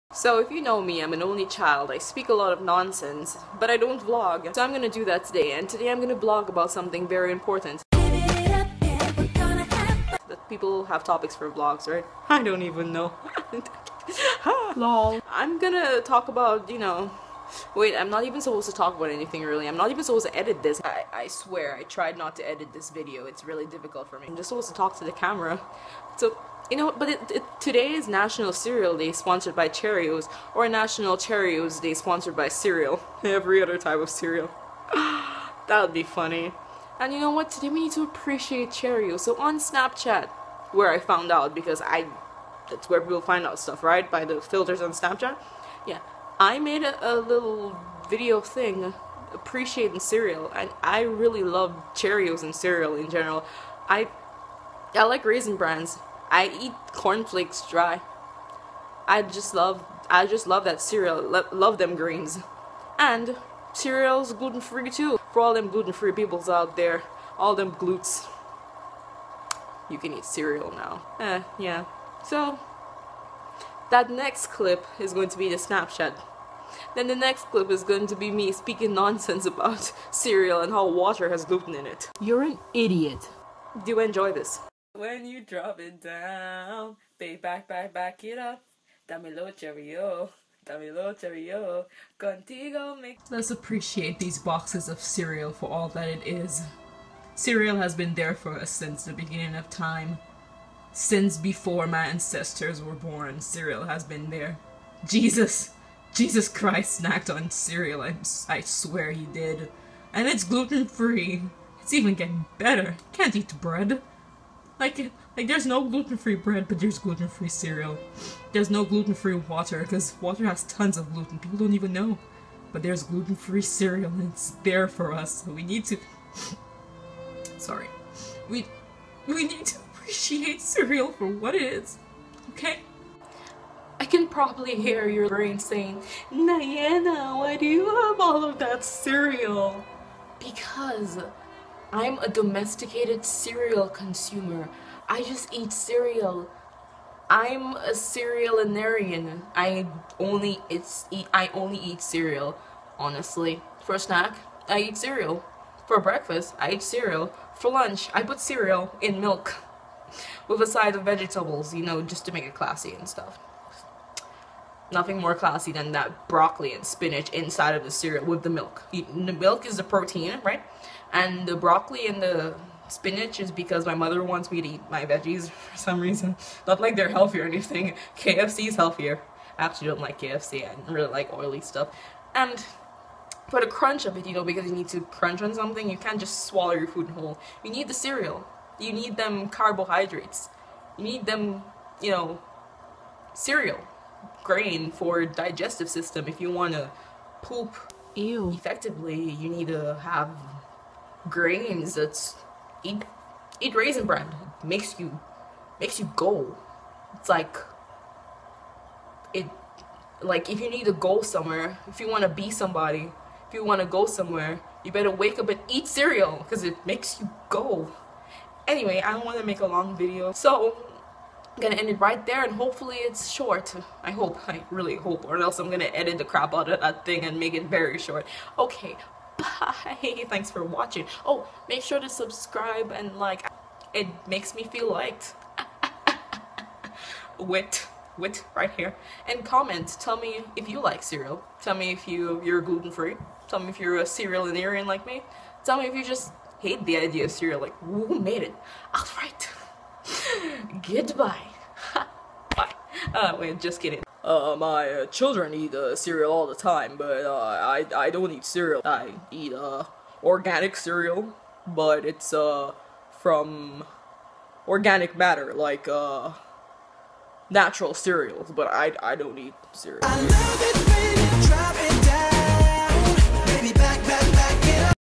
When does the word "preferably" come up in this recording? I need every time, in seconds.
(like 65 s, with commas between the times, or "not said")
not said.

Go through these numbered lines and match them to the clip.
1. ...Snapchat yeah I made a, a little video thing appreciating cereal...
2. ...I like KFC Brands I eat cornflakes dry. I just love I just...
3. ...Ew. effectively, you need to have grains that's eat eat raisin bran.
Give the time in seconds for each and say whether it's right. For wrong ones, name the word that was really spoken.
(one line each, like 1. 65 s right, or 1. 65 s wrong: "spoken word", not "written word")
1. 44 s right
2. 54 s wrong: "Raisin", not "KFC"
3. 198 s right.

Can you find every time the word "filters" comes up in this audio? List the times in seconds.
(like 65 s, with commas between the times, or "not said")
44 s.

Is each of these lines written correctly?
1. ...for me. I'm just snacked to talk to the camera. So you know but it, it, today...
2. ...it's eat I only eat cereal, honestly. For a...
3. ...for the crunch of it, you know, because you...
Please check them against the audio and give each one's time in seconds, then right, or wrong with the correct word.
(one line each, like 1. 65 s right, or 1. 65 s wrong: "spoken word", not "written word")
1. 24 s wrong: "supposed", not "snacked"
2. 150 s right
3. 183 s right.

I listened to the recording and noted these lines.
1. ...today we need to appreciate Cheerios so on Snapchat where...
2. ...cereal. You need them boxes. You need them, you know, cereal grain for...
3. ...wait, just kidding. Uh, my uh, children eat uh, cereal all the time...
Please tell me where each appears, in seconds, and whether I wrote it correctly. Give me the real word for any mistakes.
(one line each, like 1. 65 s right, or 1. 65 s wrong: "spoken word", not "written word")
1. 37 s right
2. 187 s wrong: "carbohydrates", not "boxes"
3. 253 s right.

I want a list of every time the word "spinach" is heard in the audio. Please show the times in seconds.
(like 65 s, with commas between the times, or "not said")
166 s, 172 s.